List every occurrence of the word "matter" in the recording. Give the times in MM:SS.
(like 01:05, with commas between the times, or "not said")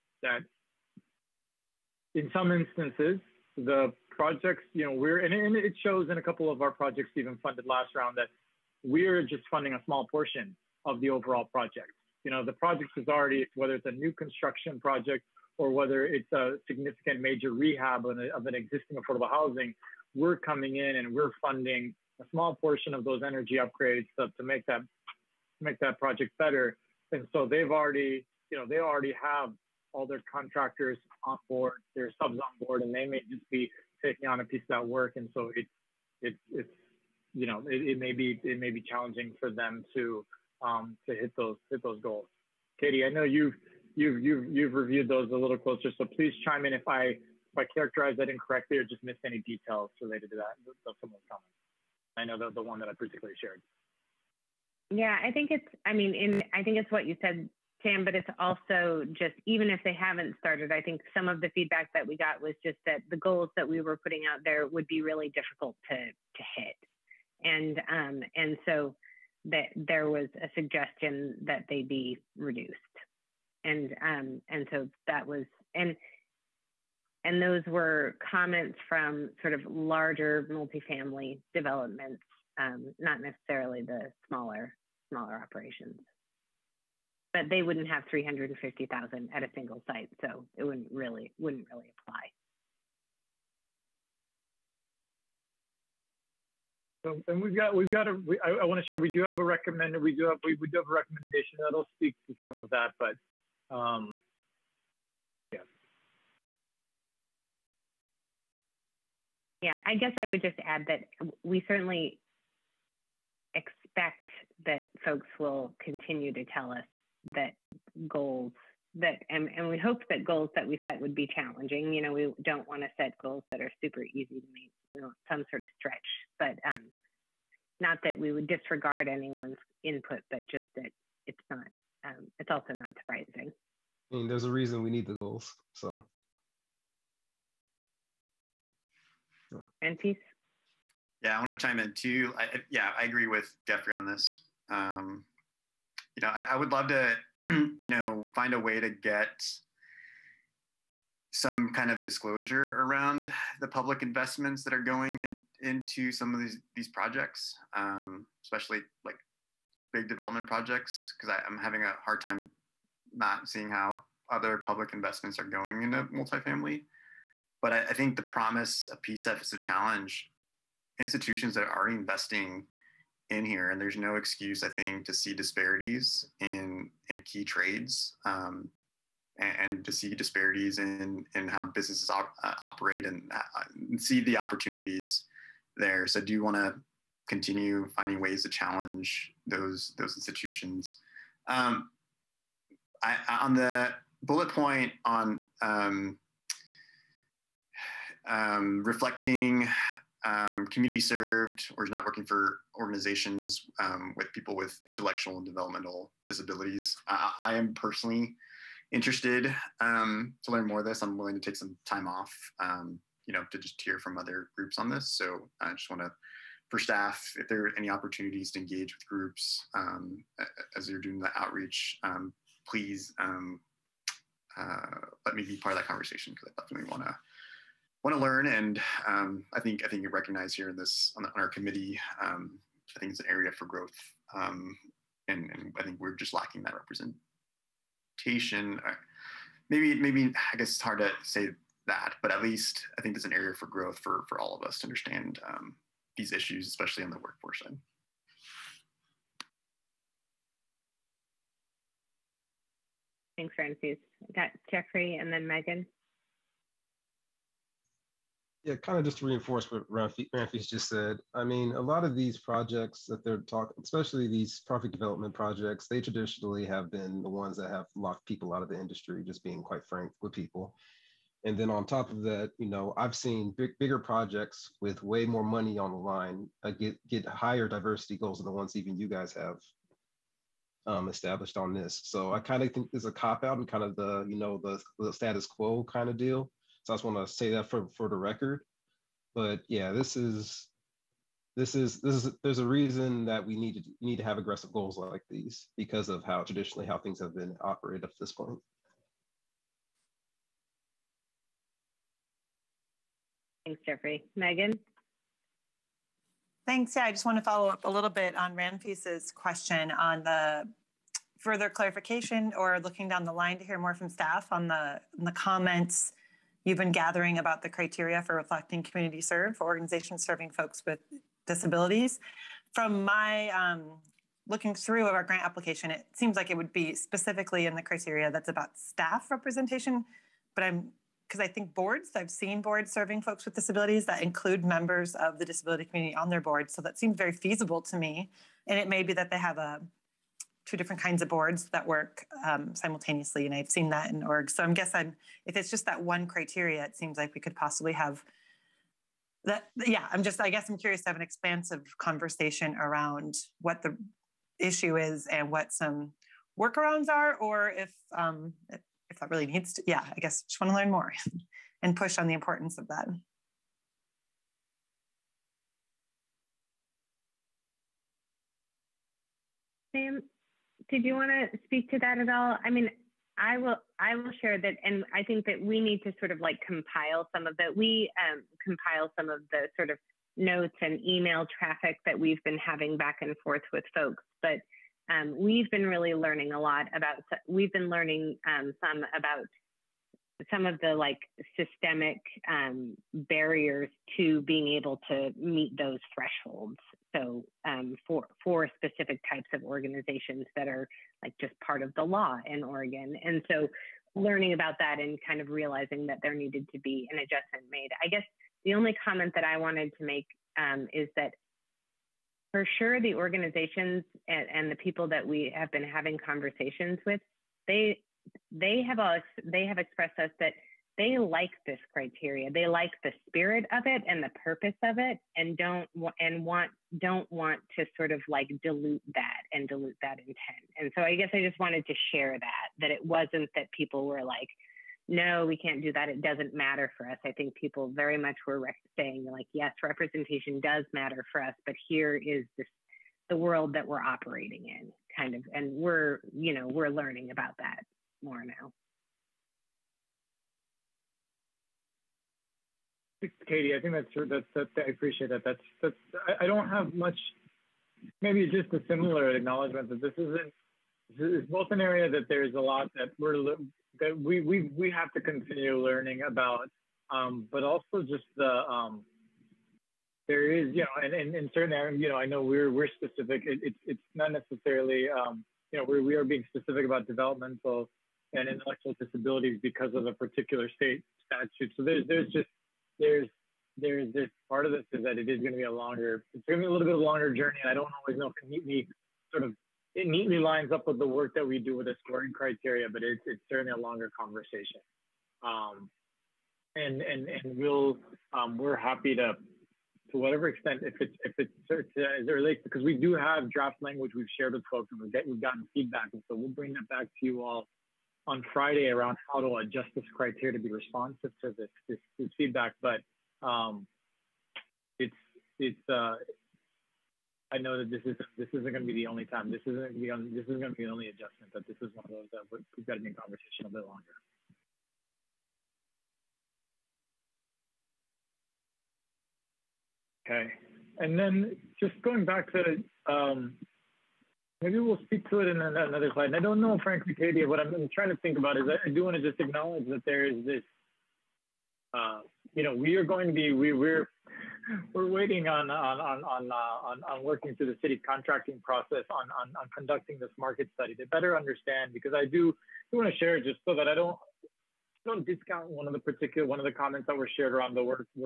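07:16, 07:20.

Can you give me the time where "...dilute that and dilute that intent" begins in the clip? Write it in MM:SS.
07:08.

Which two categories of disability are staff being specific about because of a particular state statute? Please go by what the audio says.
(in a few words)
developmental and intellectual.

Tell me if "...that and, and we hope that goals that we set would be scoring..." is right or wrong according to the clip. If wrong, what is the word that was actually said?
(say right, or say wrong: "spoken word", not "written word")
wrong: "challenging", not "scoring".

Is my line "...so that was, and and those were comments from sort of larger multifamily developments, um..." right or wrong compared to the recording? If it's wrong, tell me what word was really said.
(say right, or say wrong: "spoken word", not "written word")
right.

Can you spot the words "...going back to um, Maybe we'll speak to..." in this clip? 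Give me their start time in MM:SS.
08:52.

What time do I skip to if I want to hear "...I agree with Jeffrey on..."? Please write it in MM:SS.
02:22.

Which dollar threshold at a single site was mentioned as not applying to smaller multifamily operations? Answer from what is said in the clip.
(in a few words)
350,000.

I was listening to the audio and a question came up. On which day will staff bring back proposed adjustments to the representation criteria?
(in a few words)
Friday.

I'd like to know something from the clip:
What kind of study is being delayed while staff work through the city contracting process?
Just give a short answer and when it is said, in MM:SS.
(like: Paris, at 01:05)
market study, at 09:10.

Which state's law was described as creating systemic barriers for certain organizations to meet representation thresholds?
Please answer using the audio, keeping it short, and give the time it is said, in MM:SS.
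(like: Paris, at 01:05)
Oregon, at 06:42.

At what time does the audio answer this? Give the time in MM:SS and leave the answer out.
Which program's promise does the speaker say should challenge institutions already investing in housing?
02:49.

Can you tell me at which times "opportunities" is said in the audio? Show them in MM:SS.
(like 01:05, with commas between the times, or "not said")
03:04, 03:37.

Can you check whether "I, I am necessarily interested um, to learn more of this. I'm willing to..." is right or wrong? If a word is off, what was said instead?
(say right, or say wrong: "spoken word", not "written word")
wrong: "personally", not "necessarily".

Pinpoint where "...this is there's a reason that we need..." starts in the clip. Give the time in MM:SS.
04:52.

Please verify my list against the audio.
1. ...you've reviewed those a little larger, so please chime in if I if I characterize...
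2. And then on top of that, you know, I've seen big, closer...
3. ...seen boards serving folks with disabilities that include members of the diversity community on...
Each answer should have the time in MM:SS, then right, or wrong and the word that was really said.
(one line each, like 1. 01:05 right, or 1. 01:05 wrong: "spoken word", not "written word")
1. 00:44 wrong: "closer", not "larger"
2. 04:31 wrong: "bigger", not "closer"
3. 05:32 wrong: "disability", not "diversity".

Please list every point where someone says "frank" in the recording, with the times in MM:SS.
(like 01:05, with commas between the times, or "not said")
04:29, 08:56.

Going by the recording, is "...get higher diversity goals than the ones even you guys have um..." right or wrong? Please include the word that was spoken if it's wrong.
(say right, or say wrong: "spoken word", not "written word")
right.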